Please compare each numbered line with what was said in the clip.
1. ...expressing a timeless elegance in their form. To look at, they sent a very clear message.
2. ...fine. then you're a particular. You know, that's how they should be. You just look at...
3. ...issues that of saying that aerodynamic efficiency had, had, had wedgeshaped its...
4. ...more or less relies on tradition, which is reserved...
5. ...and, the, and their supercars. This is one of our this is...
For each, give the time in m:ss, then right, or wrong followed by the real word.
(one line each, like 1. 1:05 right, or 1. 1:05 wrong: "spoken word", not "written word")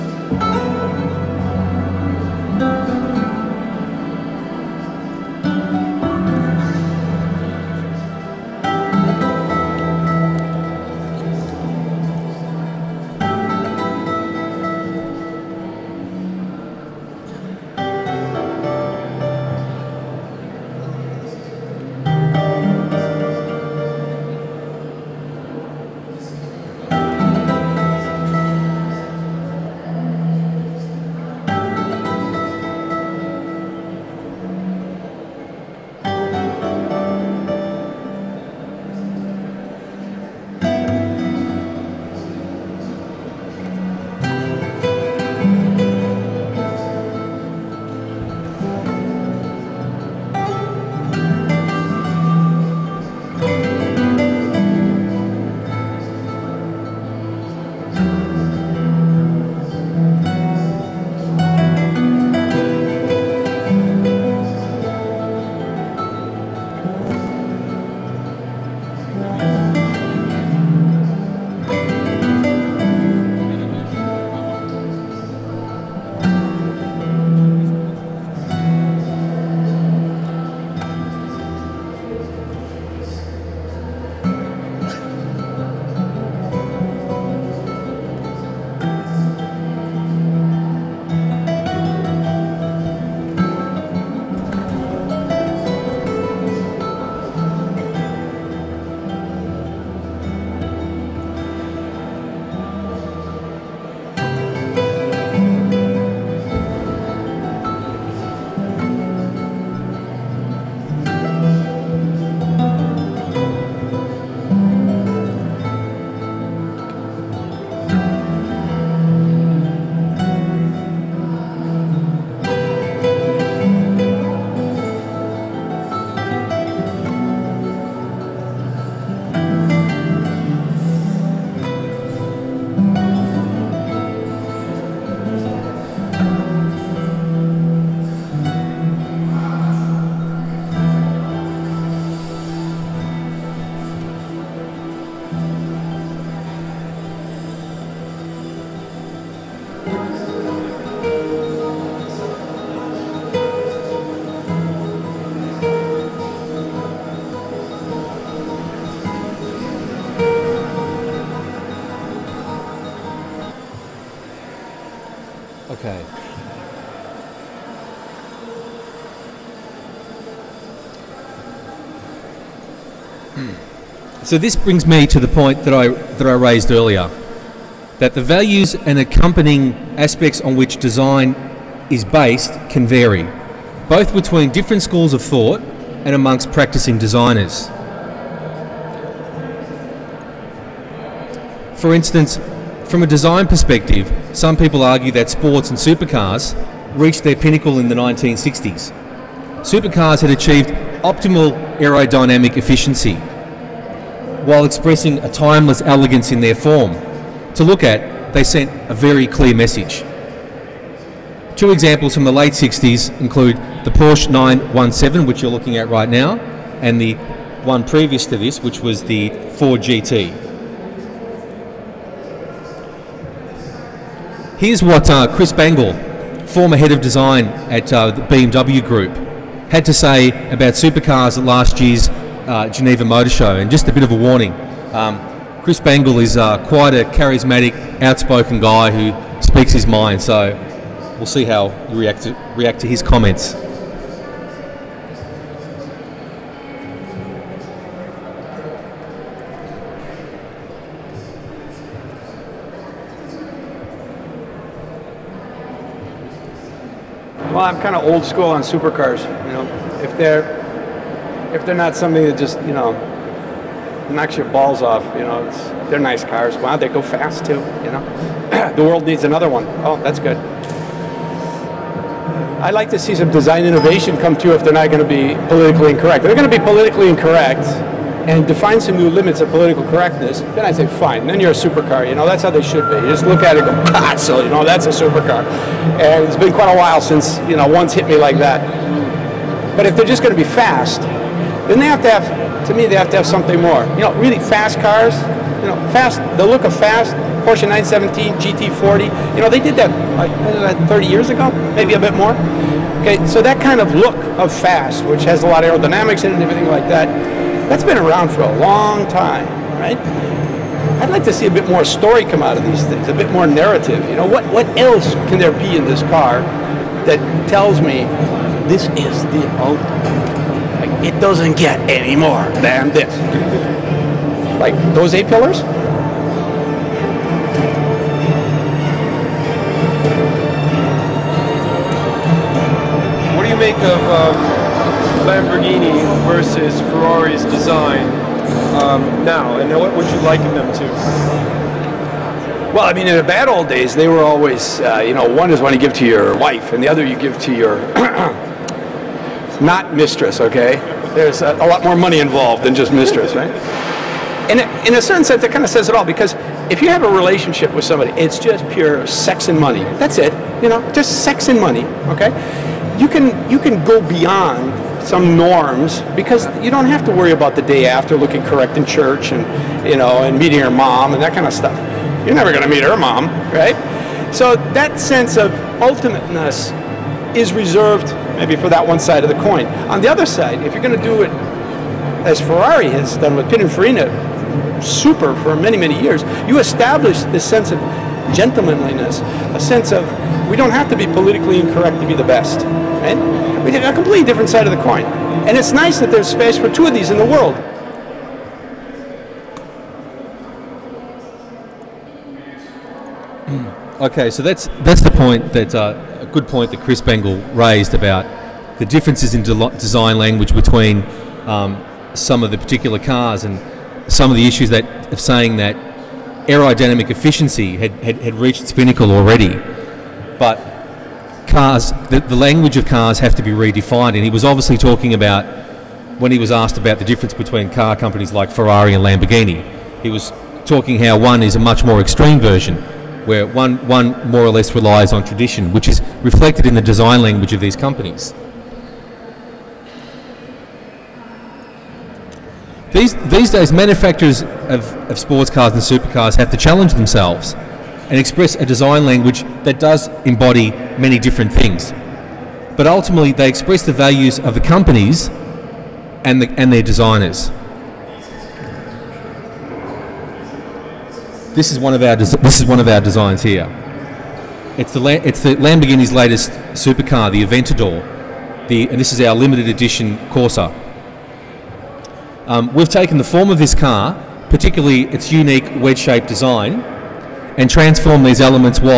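1. 3:24 right
2. 4:40 wrong: "supercar", not "particular"
3. 6:54 wrong: "reached", not "wedgeshaped"
4. 7:14 wrong: "reflected", not "reserved"
5. 7:36 wrong: "designers", not "supercars".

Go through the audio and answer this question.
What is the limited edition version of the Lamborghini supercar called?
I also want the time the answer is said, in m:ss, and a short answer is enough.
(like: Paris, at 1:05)
Corsa, at 7:50.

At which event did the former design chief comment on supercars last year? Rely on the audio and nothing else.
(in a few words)
Geneva Motor Show.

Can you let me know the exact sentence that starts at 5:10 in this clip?
I'd like to see a bit more story come out of these things, a bit more narrative.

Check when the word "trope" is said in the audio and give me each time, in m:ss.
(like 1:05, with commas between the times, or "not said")
not said.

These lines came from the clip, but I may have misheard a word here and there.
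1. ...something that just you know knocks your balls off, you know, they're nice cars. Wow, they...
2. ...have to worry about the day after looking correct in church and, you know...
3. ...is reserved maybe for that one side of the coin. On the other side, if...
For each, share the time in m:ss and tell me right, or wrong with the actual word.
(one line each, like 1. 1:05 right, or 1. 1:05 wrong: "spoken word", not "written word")
1. 4:21 right
2. 6:06 right
3. 6:17 right.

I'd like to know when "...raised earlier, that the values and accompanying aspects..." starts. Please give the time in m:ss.
2:56.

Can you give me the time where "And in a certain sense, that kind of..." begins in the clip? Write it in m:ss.
5:54.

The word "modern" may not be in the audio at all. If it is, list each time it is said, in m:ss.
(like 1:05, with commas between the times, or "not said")
not said.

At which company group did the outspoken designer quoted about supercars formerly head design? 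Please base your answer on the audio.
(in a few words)
BMW Group.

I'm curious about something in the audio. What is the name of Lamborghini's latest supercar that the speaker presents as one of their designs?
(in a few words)
Aventador.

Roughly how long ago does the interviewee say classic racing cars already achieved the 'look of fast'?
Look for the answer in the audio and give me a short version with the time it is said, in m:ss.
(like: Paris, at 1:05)
30 years ago, at 5:00.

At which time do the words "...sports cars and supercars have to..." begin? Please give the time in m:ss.
7:25.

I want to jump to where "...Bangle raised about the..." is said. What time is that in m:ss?
6:46.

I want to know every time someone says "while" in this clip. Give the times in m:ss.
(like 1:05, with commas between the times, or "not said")
3:24, 4:46.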